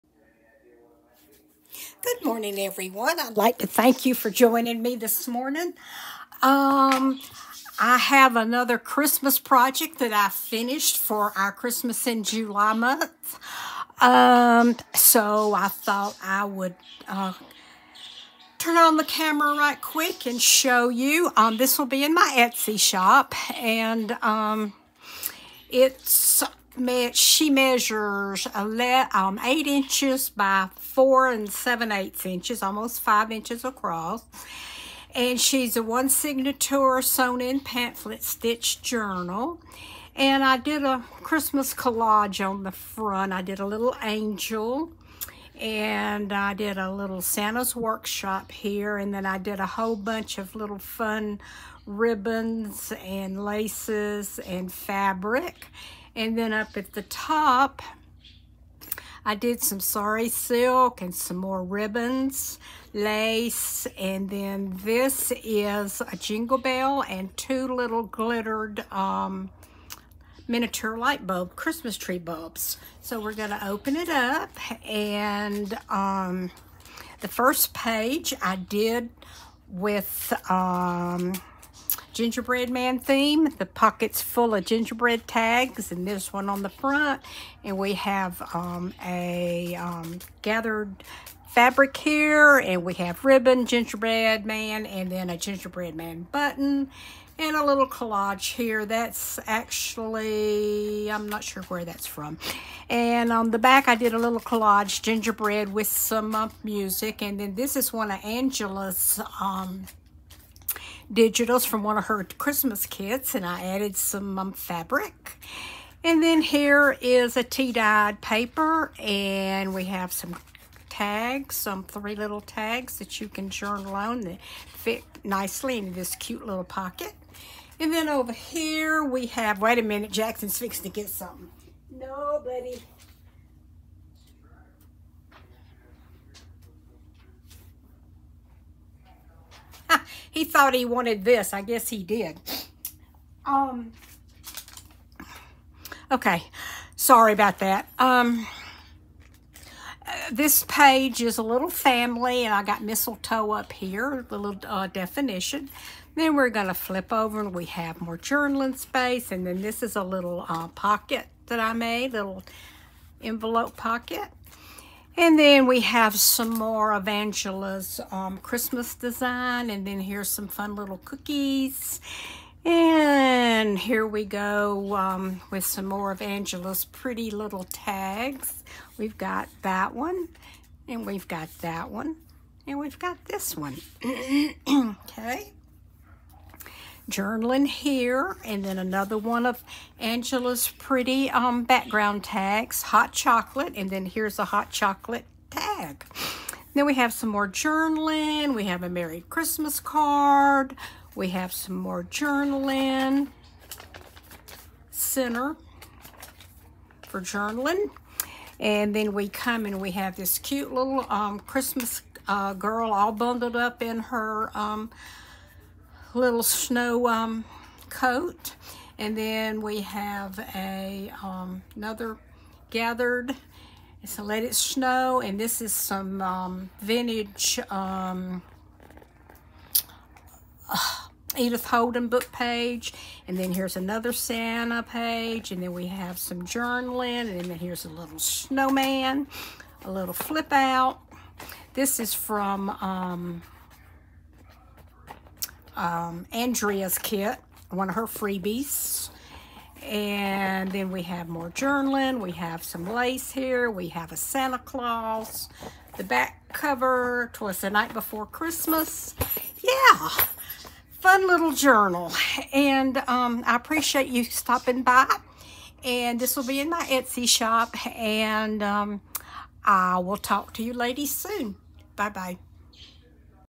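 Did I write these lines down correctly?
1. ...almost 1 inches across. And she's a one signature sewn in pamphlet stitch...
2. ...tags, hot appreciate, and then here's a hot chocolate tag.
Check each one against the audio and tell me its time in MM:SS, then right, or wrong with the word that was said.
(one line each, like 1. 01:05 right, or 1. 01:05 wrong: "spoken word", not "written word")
1. 00:32 wrong: "5", not "1"
2. 03:12 wrong: "chocolate", not "appreciate".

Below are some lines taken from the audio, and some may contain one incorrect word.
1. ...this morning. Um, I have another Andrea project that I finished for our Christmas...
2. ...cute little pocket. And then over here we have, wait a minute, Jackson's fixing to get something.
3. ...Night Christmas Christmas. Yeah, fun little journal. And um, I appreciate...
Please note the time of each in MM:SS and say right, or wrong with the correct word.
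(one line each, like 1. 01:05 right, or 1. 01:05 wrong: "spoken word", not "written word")
1. 00:04 wrong: "Christmas", not "Andrea"
2. 02:06 right
3. 04:17 wrong: "Before", not "Christmas".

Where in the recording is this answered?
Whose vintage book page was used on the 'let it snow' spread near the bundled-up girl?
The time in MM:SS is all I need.
03:51.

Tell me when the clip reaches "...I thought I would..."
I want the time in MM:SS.
00:15.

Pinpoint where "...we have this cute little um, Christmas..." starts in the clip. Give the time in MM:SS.
03:29.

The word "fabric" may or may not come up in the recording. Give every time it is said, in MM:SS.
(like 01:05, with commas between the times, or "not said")
00:54, 01:31, 01:54.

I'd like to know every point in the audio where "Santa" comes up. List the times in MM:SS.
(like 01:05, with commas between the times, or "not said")
00:47, 03:54, 04:14.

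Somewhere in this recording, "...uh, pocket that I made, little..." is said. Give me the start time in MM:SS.
02:40.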